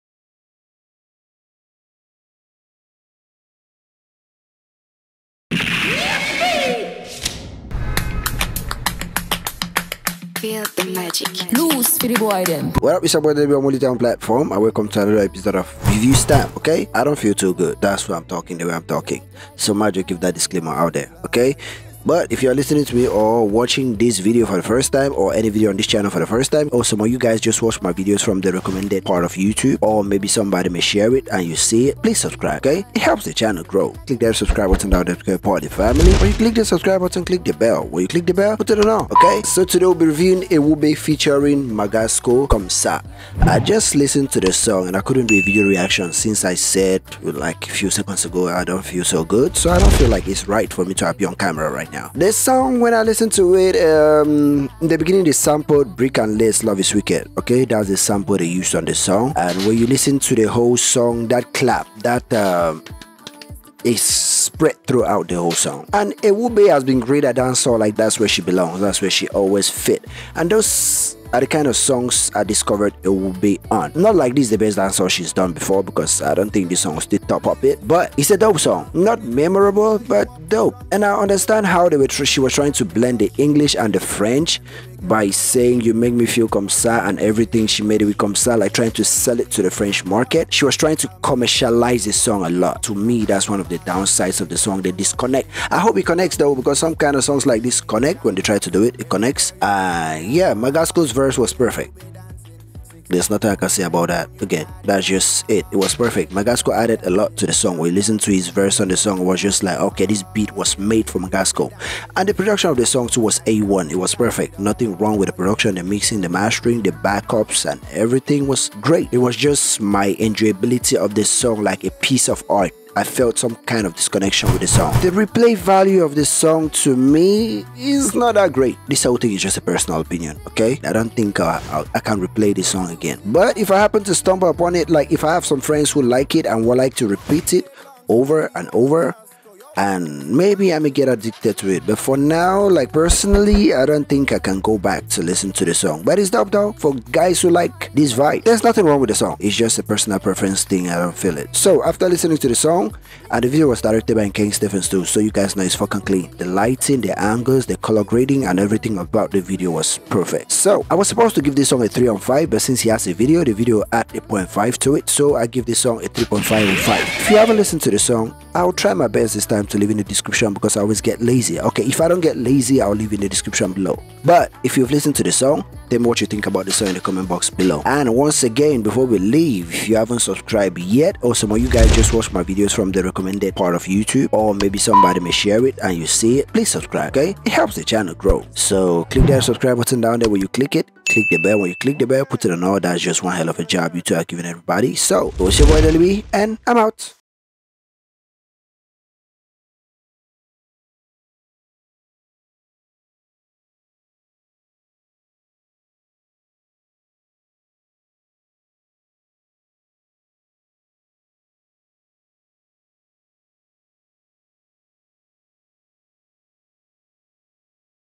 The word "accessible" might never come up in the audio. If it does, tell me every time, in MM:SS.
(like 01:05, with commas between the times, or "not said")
not said.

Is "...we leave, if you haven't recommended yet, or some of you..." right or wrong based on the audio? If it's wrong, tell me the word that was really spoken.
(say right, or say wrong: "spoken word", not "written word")
wrong: "subscribed", not "recommended".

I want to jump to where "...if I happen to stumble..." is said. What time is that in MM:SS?
02:13.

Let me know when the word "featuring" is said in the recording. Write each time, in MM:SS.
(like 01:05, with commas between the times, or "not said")
00:40.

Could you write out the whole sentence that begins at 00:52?
This song, when I listen to it, um, in the beginning they sampled Brick and Lace Love is Wicked, okay?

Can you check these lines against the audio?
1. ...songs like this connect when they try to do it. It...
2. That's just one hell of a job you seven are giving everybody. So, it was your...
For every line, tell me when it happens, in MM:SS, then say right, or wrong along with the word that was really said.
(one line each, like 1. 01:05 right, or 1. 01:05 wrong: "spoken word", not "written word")
1. 01:37 right
2. 03:12 wrong: "two", not "seven".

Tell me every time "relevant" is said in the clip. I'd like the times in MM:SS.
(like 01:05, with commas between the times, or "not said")
not said.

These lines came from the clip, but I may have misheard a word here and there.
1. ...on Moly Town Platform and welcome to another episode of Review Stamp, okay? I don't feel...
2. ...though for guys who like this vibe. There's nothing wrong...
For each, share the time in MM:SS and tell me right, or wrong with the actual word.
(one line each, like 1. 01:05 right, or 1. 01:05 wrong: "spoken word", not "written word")
1. 00:13 right
2. 02:26 right.